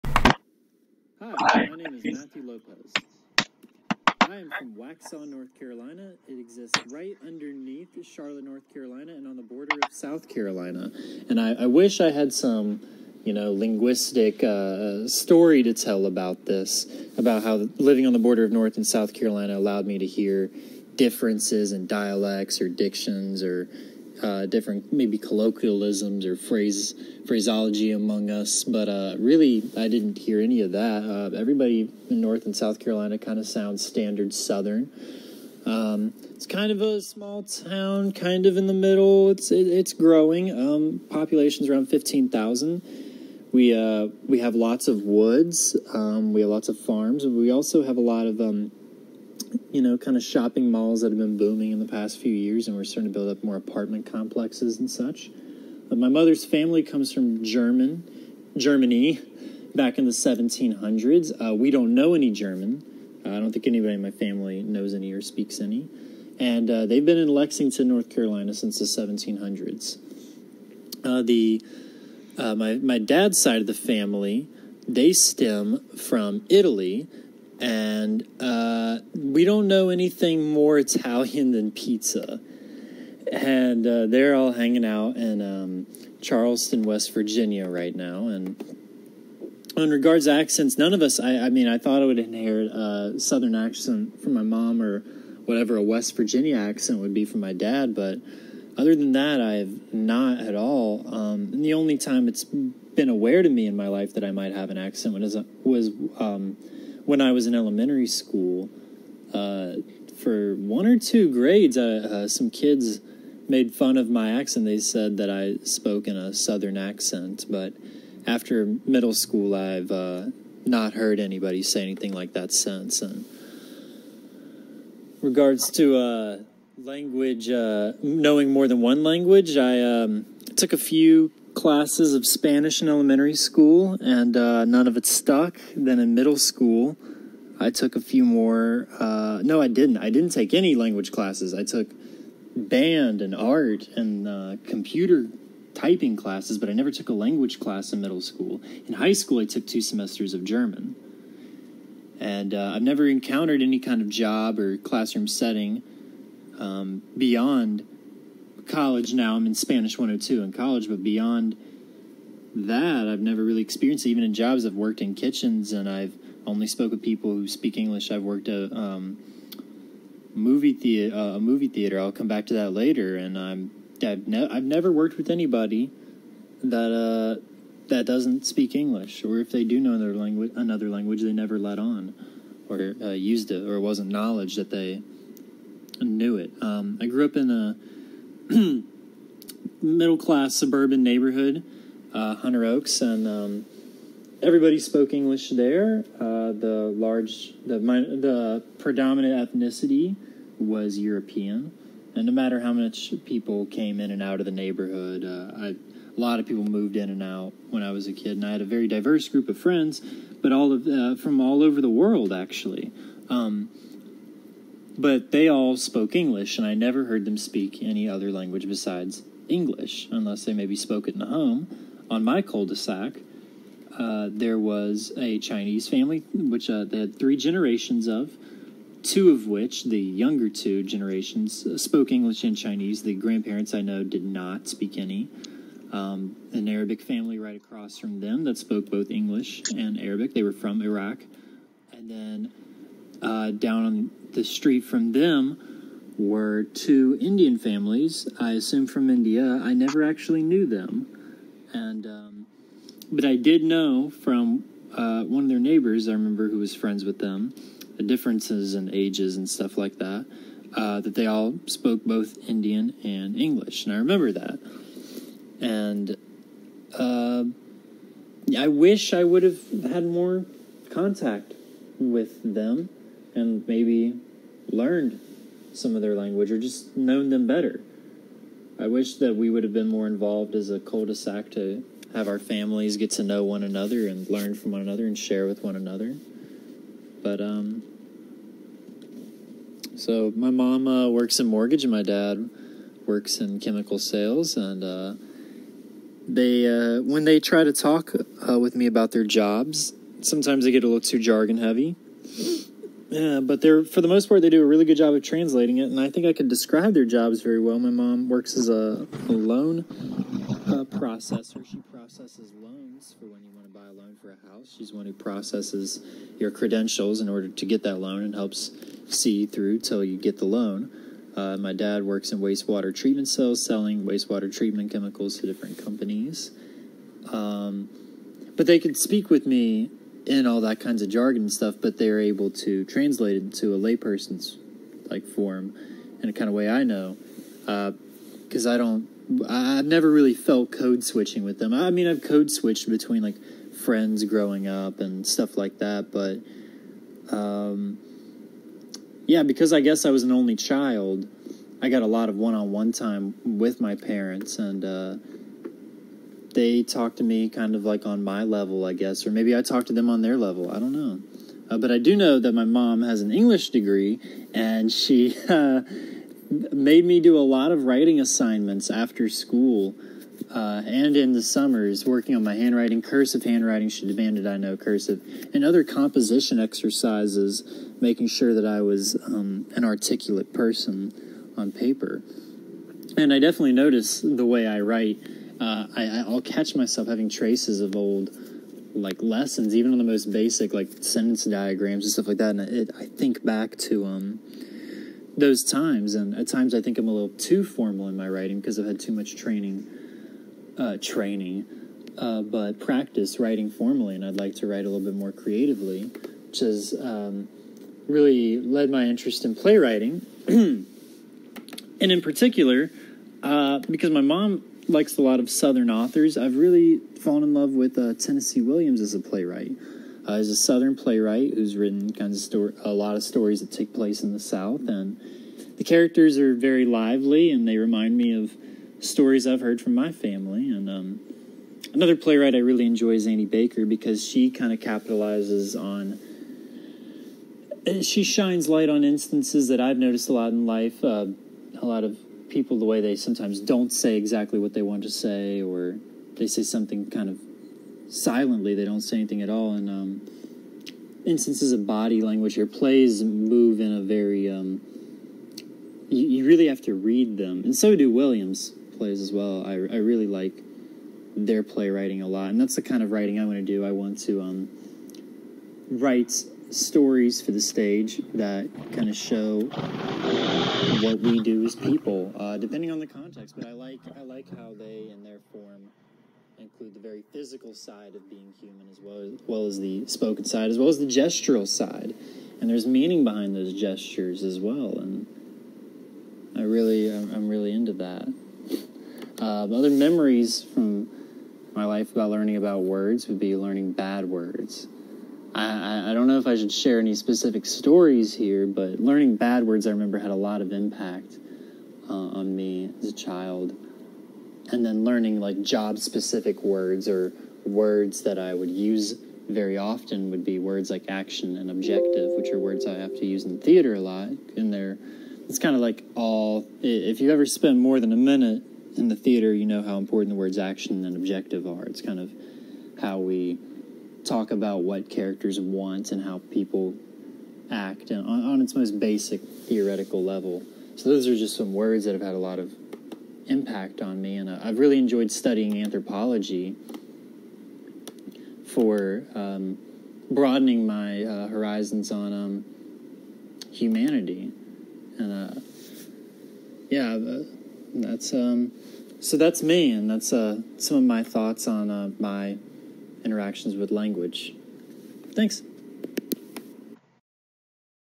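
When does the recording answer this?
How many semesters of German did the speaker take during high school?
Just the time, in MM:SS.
02:29.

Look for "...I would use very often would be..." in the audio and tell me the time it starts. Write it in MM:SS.
08:28.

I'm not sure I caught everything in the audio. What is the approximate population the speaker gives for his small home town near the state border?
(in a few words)
15,000.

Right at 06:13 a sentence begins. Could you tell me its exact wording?
She demanded I know cursive, and other composition exercises, making sure that I was um, an articulate person on paper.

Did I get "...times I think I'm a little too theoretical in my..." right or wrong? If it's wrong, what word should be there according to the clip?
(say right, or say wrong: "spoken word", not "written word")
wrong: "formal", not "theoretical".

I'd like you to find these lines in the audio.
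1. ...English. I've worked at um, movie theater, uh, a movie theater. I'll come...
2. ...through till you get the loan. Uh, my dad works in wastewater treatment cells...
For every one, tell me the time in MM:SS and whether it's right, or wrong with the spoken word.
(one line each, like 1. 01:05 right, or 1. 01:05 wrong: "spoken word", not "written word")
1. 02:47 right
2. 05:19 right.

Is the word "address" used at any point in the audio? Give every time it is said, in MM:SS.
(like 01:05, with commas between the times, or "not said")
not said.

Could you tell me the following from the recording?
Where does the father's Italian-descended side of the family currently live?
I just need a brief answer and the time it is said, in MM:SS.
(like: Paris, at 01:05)
Charleston, West Virginia, at 01:26.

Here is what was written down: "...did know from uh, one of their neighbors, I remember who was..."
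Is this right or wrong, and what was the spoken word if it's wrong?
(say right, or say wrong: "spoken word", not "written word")
right.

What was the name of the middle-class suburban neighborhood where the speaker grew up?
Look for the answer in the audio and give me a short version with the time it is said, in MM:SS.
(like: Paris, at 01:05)
Hunter Oaks, at 03:12.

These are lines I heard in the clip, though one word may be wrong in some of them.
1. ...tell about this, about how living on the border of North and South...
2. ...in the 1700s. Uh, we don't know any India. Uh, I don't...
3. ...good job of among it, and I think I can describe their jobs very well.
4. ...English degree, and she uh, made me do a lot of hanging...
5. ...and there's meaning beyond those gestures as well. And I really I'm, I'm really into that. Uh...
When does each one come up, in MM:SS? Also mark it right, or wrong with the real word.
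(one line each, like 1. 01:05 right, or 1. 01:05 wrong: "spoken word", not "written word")
1. 00:15 right
2. 00:59 wrong: "German", not "India"
3. 05:04 wrong: "translating", not "among"
4. 06:03 wrong: "writing", not "hanging"
5. 08:02 wrong: "behind", not "beyond".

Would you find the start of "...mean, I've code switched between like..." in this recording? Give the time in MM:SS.
05:41.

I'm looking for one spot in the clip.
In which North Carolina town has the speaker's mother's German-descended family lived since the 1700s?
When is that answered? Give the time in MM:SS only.
01:07.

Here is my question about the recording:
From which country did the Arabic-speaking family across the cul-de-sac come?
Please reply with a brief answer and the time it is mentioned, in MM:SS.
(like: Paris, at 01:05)
Iraq, at 04:00.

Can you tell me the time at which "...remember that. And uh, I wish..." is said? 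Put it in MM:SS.
04:23.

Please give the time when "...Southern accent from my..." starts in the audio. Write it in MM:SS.
01:33.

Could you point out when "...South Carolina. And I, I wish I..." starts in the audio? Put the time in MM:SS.
00:09.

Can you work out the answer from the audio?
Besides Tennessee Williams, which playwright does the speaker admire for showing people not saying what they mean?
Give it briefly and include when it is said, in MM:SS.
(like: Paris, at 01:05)
Annie Baker, at 07:13.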